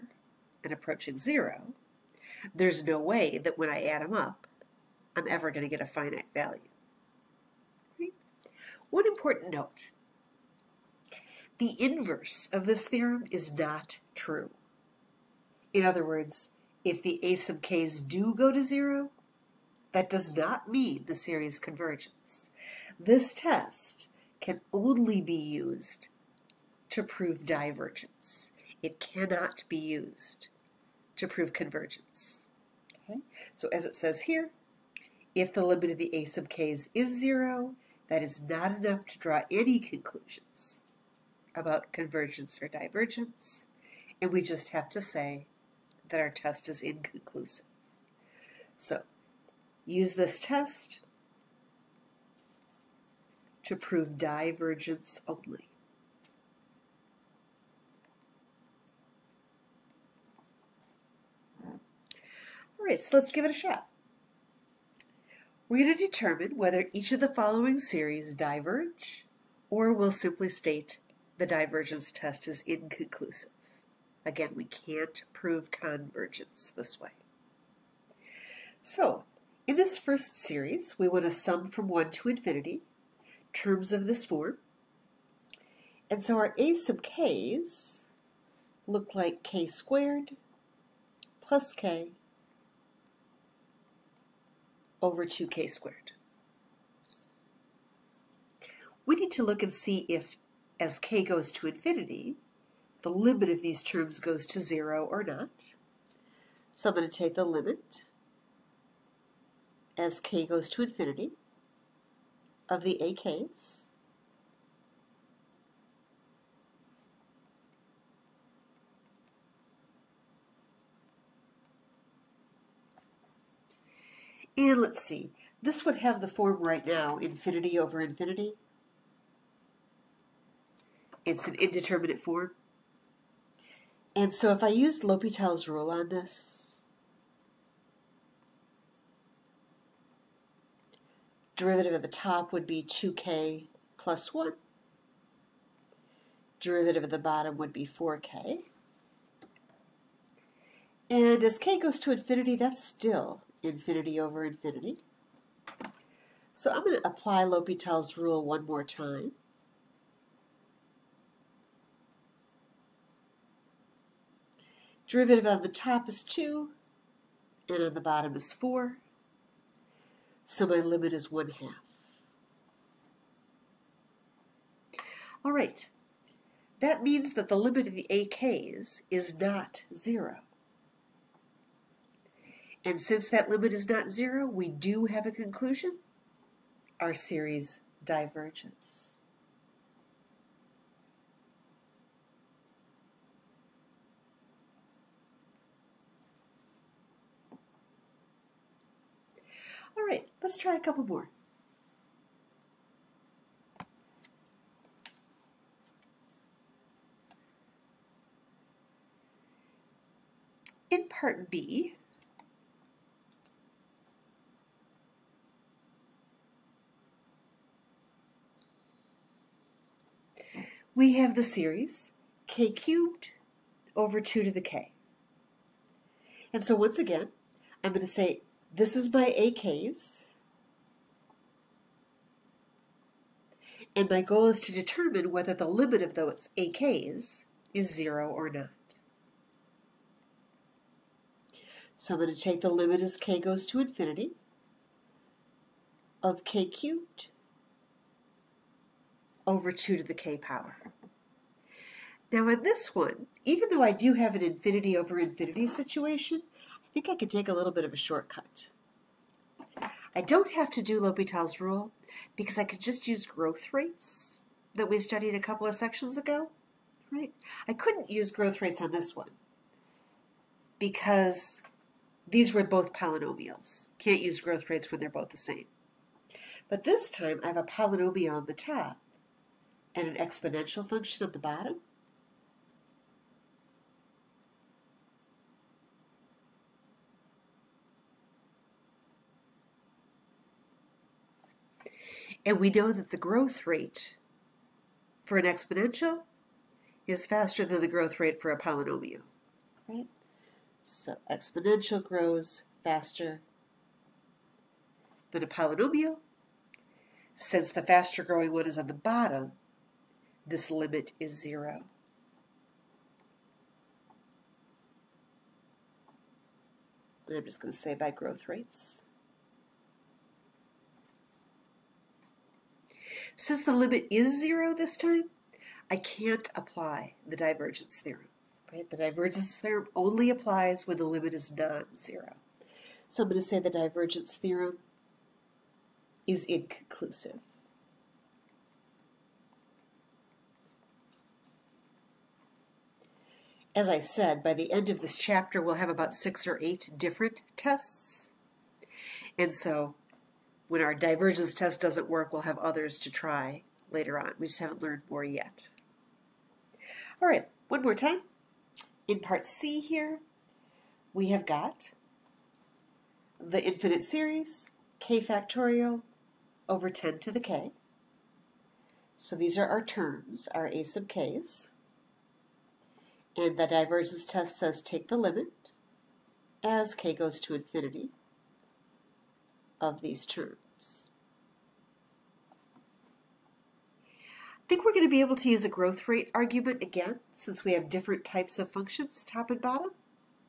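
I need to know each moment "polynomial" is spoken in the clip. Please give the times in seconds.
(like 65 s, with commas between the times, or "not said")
272 s, 277 s, 298 s, 305 s.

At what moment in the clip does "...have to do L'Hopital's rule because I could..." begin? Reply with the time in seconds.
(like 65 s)
260 s.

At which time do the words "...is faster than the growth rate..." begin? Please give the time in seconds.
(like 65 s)
297 s.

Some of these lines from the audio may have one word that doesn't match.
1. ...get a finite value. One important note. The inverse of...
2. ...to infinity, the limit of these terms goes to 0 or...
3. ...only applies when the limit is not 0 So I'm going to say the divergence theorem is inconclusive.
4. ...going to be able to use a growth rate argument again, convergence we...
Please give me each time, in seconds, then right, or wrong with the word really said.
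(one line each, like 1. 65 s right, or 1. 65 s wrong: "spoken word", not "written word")
1. 5 s right
2. 101 s right
3. 329 s right
4. 384 s wrong: "since", not "convergence".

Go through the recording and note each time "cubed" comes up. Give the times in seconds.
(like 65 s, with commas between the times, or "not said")
222 s, 246 s.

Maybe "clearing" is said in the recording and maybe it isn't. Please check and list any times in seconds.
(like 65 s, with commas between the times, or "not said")
not said.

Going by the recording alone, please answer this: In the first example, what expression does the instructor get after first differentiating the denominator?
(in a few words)
4k.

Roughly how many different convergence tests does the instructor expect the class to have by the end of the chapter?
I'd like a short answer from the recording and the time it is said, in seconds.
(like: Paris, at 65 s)
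6 or 8, at 346 s.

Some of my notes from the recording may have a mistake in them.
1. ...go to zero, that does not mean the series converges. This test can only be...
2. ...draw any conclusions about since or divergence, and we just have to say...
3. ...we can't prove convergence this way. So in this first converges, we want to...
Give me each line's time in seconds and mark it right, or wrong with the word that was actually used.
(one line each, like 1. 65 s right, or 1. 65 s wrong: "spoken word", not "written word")
1. 18 s right
2. 39 s wrong: "convergence", not "since"
3. 74 s wrong: "series", not "converges".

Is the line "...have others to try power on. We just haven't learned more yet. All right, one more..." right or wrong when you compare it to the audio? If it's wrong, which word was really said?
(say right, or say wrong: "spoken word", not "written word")
wrong: "later", not "power".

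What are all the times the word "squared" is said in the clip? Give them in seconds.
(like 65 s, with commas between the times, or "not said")
89 s, 95 s.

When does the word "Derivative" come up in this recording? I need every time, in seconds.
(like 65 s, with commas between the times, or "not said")
141 s, 146 s, 165 s.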